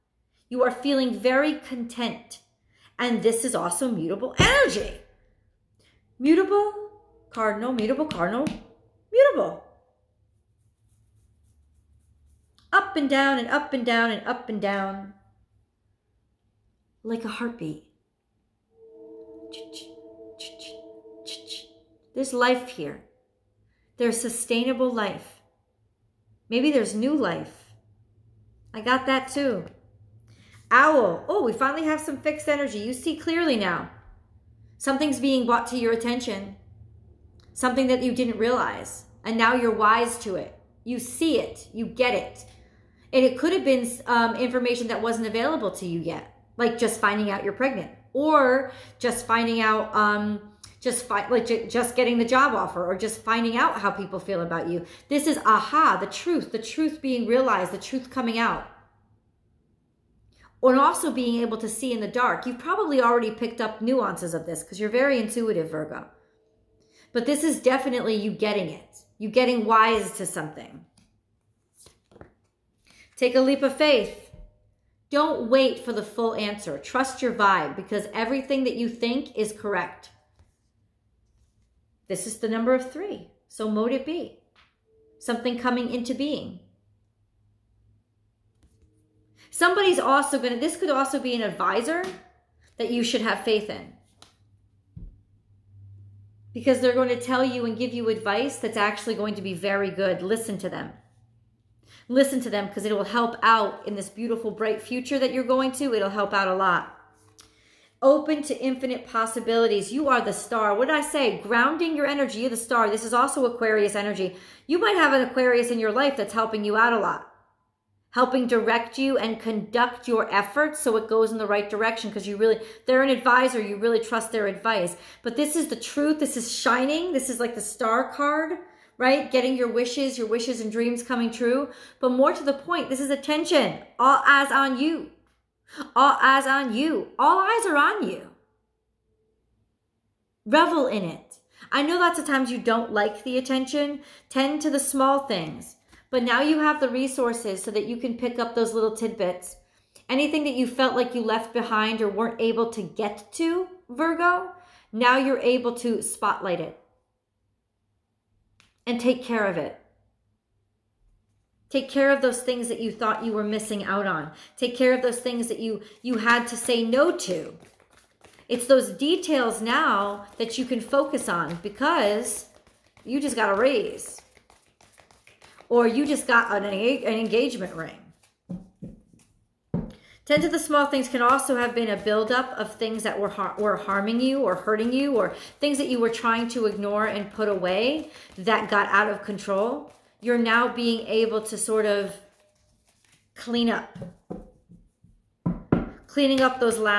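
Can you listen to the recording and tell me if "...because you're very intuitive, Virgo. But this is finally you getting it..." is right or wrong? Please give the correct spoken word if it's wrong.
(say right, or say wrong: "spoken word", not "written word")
wrong: "definitely", not "finally".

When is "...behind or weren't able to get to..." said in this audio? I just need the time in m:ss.
2:31.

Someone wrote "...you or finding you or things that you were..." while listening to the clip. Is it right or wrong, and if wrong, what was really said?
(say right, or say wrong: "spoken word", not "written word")
wrong: "hurting", not "finding".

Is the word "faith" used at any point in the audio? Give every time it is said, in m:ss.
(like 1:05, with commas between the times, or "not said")
1:13, 1:33.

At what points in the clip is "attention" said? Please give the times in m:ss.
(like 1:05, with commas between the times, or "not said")
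0:35, 2:13, 2:23.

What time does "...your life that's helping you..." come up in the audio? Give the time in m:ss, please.
1:55.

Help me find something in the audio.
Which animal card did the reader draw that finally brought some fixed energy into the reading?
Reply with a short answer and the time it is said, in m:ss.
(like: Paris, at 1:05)
Owl, at 0:30.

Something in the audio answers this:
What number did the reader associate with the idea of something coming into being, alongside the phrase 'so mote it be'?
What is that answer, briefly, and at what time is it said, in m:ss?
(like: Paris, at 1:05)
3, at 1:22.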